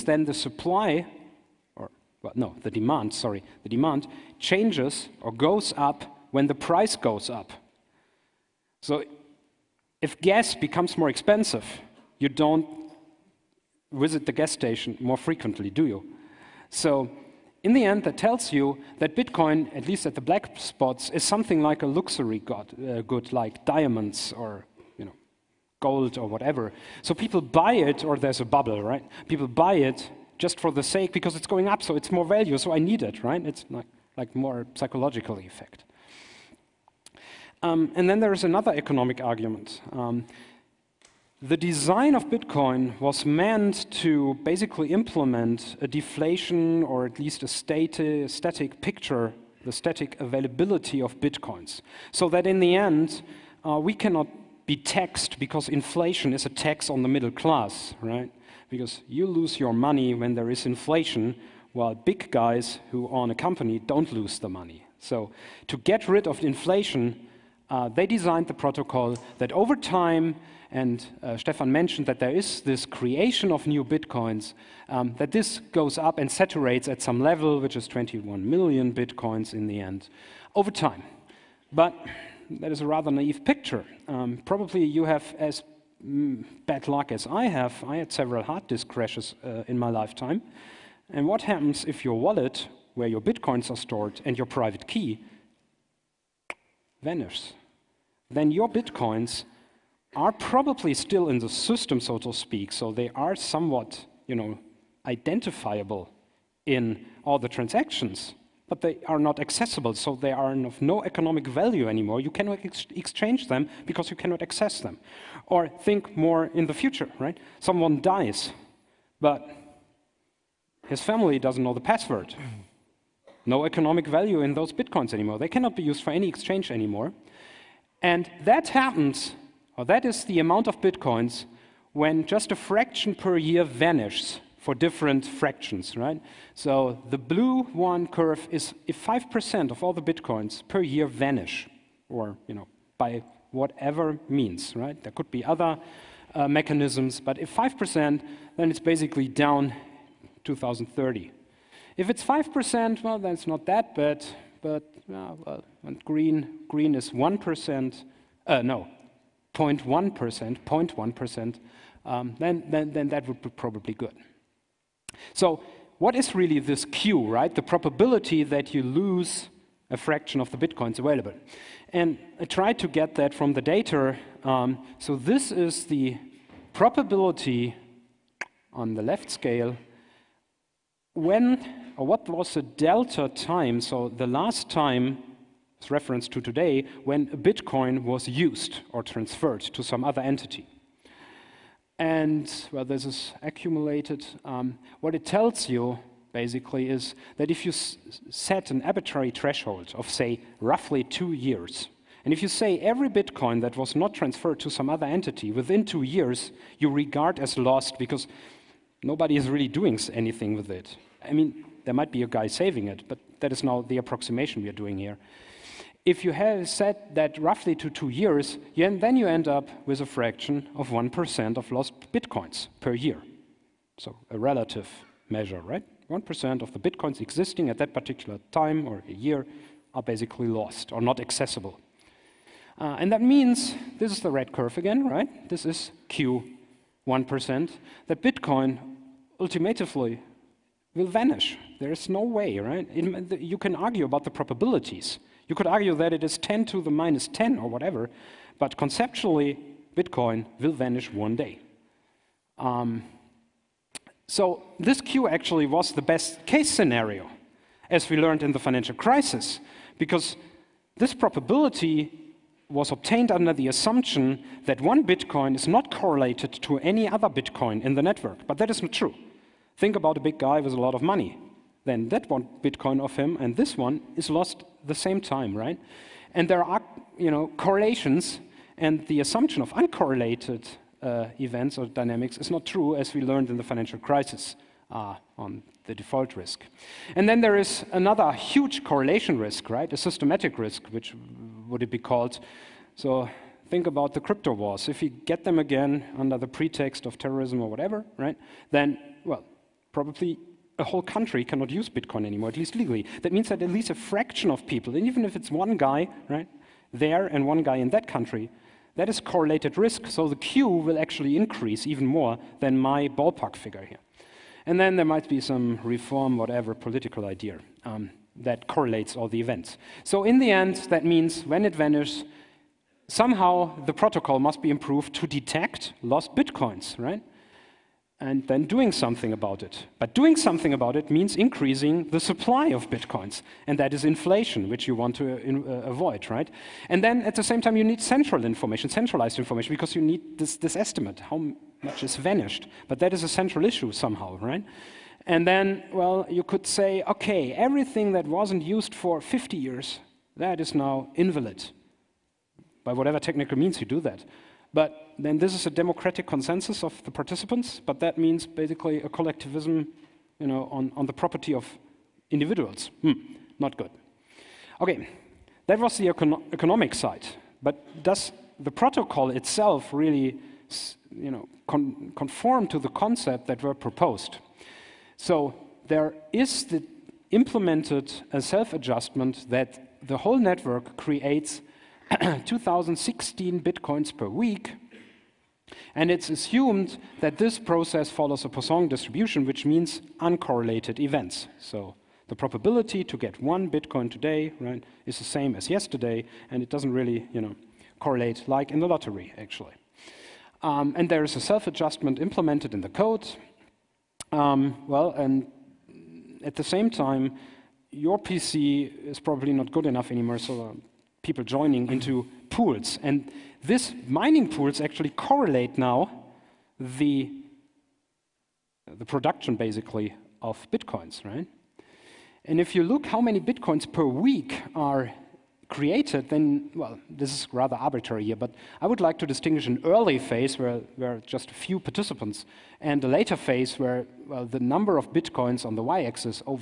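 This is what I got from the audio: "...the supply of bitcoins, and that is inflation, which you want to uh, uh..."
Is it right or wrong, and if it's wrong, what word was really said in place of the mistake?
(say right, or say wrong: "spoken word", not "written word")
right.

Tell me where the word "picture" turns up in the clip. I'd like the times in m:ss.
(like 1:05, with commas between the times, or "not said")
0:48, 1:23.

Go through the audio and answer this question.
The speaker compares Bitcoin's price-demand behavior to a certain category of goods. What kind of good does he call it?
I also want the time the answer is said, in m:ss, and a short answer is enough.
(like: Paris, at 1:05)
luxury good, at 0:21.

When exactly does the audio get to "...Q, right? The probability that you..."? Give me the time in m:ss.
2:46.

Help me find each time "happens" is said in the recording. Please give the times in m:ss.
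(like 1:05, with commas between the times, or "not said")
1:31, 2:08.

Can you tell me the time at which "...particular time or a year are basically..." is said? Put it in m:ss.
3:47.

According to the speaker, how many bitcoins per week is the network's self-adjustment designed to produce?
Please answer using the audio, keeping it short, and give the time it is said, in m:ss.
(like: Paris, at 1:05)
2016, at 6:22.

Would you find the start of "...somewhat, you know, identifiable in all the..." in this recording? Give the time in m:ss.
1:43.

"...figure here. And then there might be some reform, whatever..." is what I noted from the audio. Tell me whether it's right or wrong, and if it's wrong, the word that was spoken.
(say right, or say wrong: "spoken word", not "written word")
right.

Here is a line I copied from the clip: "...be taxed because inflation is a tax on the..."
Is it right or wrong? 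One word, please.
right.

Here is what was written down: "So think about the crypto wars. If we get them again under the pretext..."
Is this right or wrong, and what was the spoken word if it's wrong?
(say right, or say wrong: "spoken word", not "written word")
right.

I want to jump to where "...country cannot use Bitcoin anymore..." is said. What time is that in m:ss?
5:01.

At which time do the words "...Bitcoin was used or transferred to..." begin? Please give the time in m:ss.
3:07.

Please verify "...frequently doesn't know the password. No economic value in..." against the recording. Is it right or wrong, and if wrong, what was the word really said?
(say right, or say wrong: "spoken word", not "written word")
wrong: "family", not "frequently".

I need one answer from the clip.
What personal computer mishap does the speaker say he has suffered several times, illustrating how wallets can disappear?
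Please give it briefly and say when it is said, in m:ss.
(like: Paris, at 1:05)
hard disk crashes, at 1:28.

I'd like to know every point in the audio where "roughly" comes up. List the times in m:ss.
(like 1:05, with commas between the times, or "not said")
3:20, 3:37.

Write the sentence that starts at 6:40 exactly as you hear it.
Um, and there is a self-adjustment implemented in the code.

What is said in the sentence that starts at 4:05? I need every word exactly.
You could argue that it is 10 to the minus 10 or whatever, but conceptually, Bitcoin will vanish one day.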